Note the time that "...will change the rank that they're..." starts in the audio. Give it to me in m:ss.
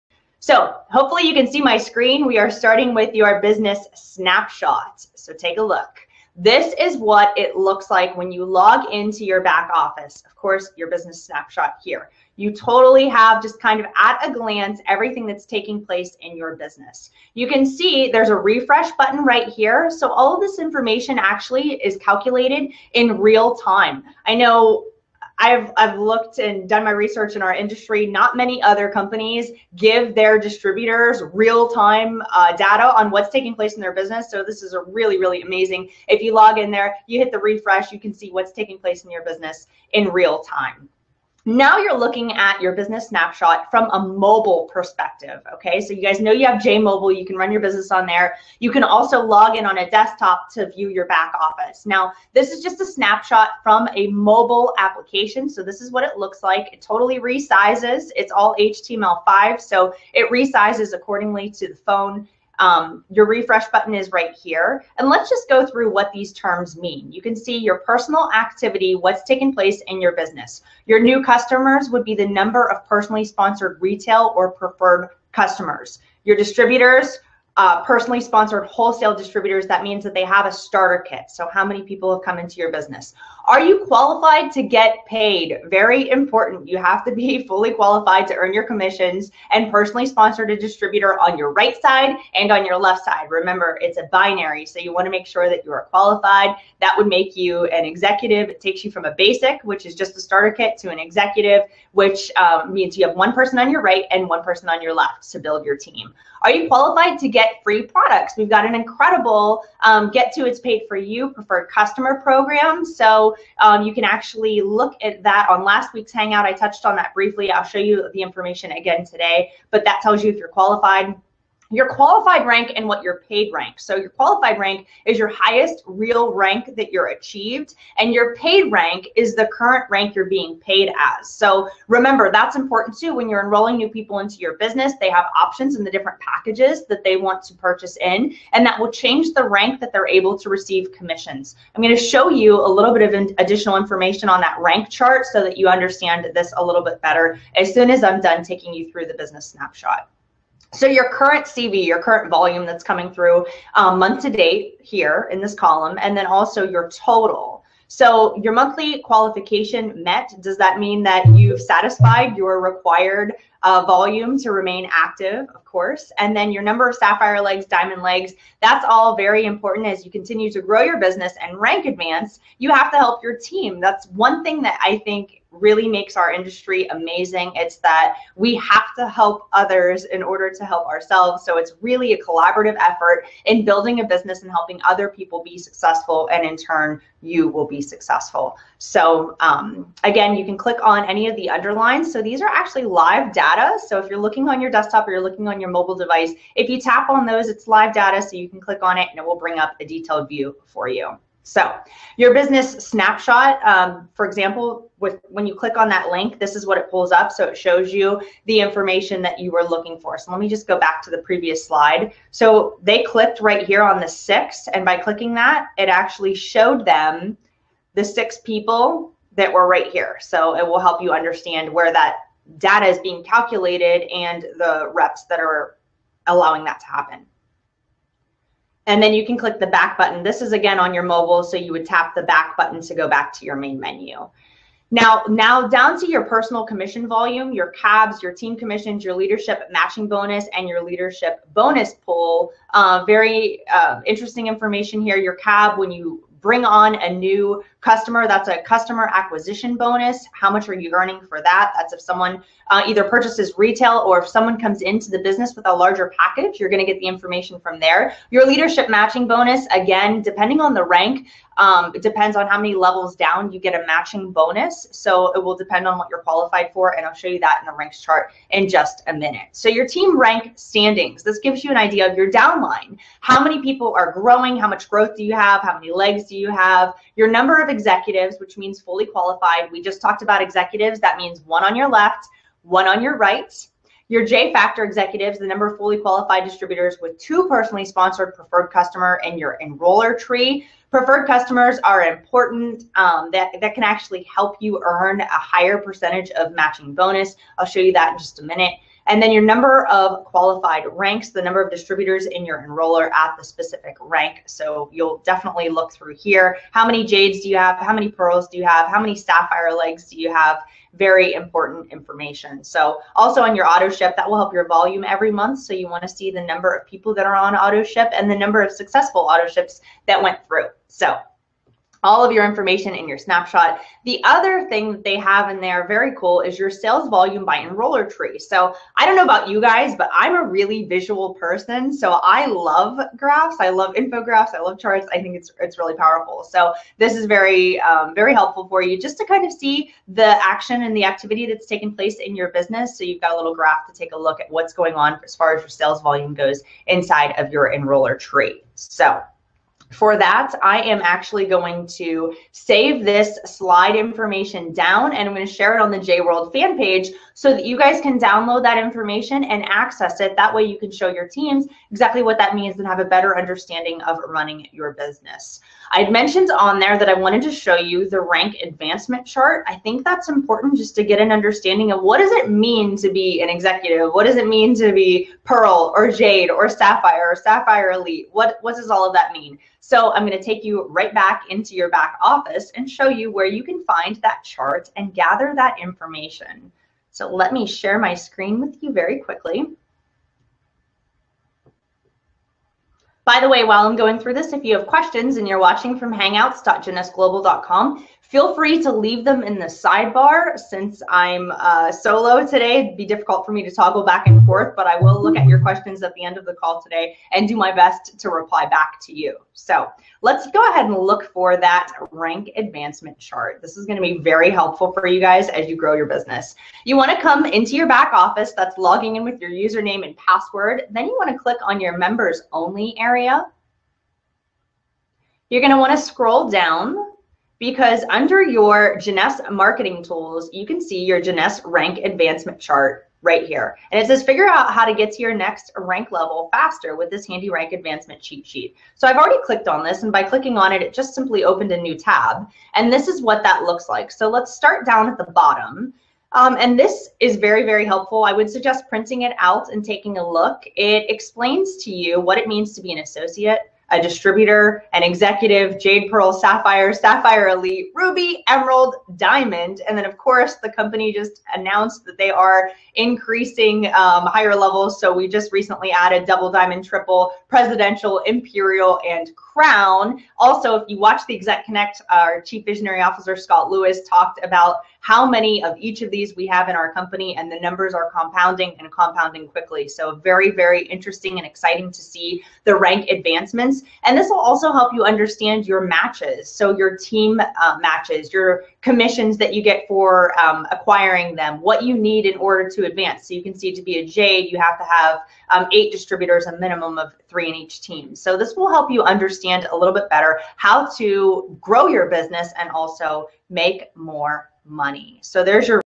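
2:18.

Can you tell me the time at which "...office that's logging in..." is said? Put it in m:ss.
6:58.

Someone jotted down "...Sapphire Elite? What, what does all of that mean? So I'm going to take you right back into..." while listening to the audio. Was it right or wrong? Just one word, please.
right.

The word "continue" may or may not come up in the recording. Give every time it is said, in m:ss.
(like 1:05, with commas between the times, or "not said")
2:50.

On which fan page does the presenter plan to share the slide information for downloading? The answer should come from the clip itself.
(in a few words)
JWorld.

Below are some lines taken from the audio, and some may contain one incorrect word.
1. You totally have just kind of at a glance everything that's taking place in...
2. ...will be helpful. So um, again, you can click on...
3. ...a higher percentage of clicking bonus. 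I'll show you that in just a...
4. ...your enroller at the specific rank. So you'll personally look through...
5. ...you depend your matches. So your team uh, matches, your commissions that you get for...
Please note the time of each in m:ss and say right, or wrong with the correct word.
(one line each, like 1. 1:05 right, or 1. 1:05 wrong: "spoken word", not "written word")
1. 0:12 right
2. 3:07 wrong: "successful", not "helpful"
3. 4:55 wrong: "matching", not "clicking"
4. 5:02 wrong: "definitely", not "personally"
5. 8:04 wrong: "understand", not "depend".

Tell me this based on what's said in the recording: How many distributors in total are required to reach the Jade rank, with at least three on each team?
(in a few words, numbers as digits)
8.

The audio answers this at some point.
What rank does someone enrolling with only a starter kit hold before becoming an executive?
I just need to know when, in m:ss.
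1:39.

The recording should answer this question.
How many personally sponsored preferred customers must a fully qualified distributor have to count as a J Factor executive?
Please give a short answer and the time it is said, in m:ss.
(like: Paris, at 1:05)
2, at 4:47.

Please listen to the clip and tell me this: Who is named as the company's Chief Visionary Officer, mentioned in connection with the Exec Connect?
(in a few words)
Scott Lewis.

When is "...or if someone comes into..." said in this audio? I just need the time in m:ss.
4:14.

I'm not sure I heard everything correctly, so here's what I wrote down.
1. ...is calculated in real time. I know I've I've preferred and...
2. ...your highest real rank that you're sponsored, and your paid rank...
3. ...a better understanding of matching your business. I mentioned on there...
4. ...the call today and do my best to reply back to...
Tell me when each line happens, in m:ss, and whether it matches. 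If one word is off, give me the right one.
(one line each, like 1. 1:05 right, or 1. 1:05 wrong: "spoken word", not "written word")
1. 0:21 wrong: "looked", not "preferred"
2. 2:05 wrong: "achieved", not "sponsored"
3. 6:02 wrong: "running", not "matching"
4. 6:46 right.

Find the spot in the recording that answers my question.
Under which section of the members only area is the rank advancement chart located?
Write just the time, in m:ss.
7:08.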